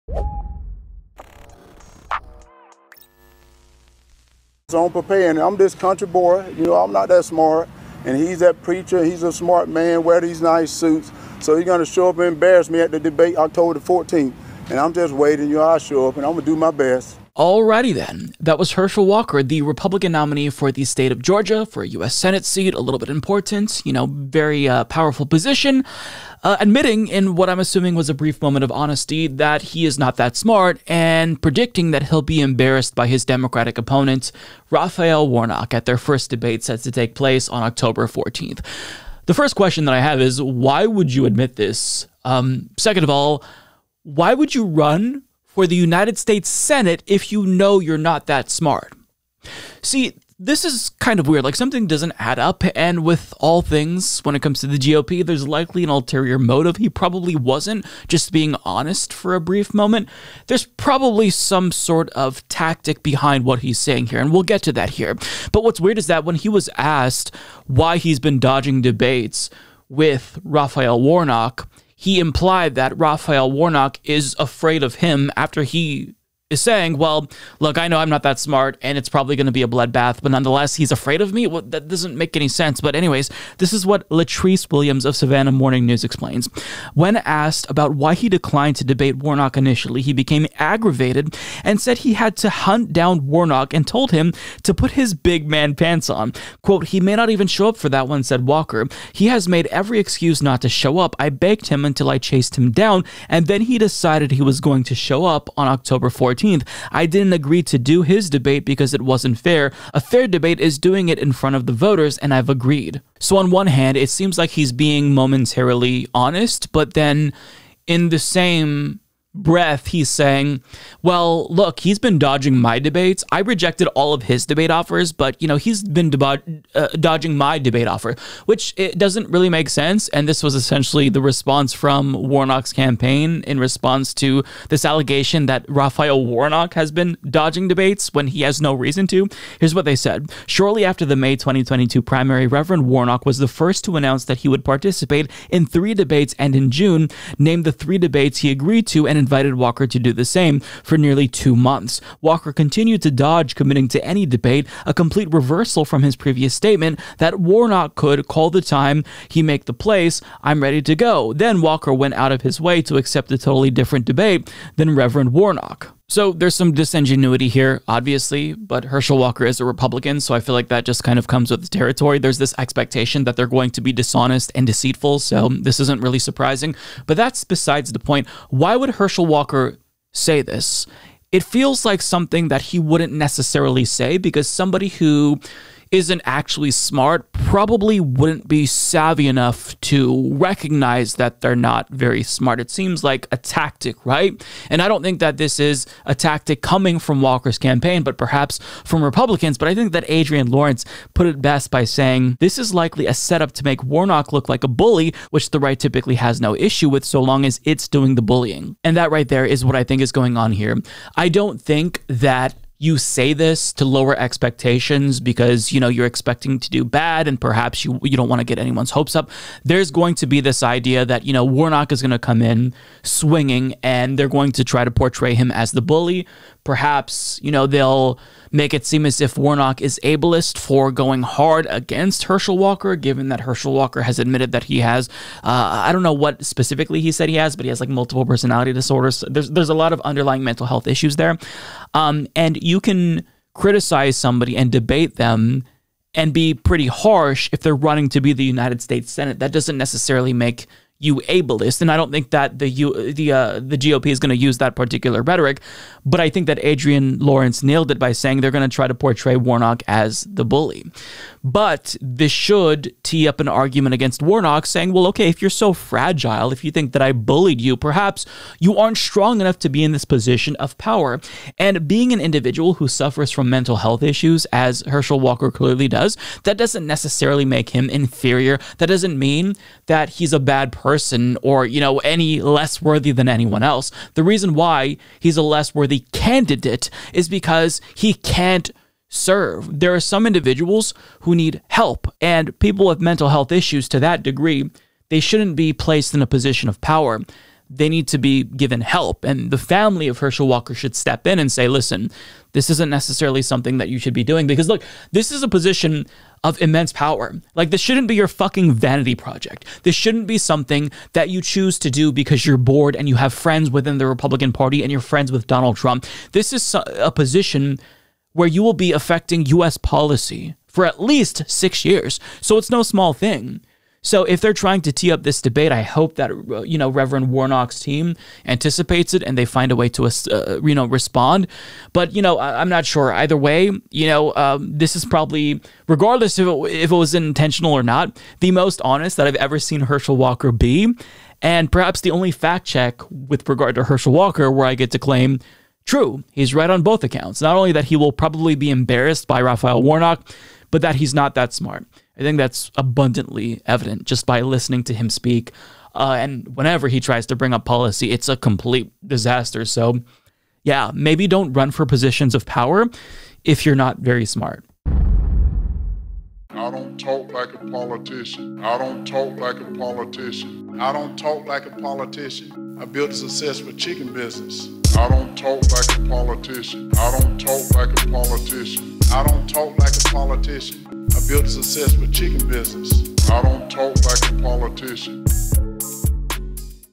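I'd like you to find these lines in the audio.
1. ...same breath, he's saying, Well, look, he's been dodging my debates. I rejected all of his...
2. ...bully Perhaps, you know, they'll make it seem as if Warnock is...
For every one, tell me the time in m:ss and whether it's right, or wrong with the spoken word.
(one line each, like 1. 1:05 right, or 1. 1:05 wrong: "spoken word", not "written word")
1. 1:58 right
2. 3:45 right.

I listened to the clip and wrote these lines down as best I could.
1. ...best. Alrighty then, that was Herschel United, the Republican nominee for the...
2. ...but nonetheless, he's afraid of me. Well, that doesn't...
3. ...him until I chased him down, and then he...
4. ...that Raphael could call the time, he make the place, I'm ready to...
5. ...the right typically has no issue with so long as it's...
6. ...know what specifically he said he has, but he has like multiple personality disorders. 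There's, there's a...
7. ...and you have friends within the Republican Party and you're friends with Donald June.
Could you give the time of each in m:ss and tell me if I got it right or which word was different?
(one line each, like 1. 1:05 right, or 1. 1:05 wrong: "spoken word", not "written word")
1. 0:16 wrong: "Walker", not "United"
2. 1:20 right
3. 1:41 right
4. 2:37 wrong: "Warnock", not "Raphael"
5. 3:25 right
6. 3:56 right
7. 5:12 wrong: "Trump", not "June".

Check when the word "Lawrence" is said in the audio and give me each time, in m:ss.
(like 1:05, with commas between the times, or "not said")
3:20, 4:17.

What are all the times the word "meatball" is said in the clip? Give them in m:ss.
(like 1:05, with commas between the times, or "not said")
not said.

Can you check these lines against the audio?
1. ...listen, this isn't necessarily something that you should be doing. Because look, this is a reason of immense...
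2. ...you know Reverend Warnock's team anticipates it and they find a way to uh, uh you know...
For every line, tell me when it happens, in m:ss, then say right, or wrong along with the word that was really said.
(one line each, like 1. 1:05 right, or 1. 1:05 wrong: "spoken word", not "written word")
1. 5:01 wrong: "position", not "reason"
2. 5:26 right.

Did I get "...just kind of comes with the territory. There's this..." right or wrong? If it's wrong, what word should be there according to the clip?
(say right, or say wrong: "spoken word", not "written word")
right.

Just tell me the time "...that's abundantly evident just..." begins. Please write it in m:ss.
5:52.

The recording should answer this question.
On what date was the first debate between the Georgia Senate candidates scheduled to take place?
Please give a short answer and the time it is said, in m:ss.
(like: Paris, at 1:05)
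October 14th, at 0:13.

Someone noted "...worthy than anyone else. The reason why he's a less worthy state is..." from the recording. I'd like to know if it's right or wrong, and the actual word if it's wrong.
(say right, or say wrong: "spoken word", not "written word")
wrong: "candidate", not "state".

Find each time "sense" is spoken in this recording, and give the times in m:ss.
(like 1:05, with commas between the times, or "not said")
1:22, 2:09.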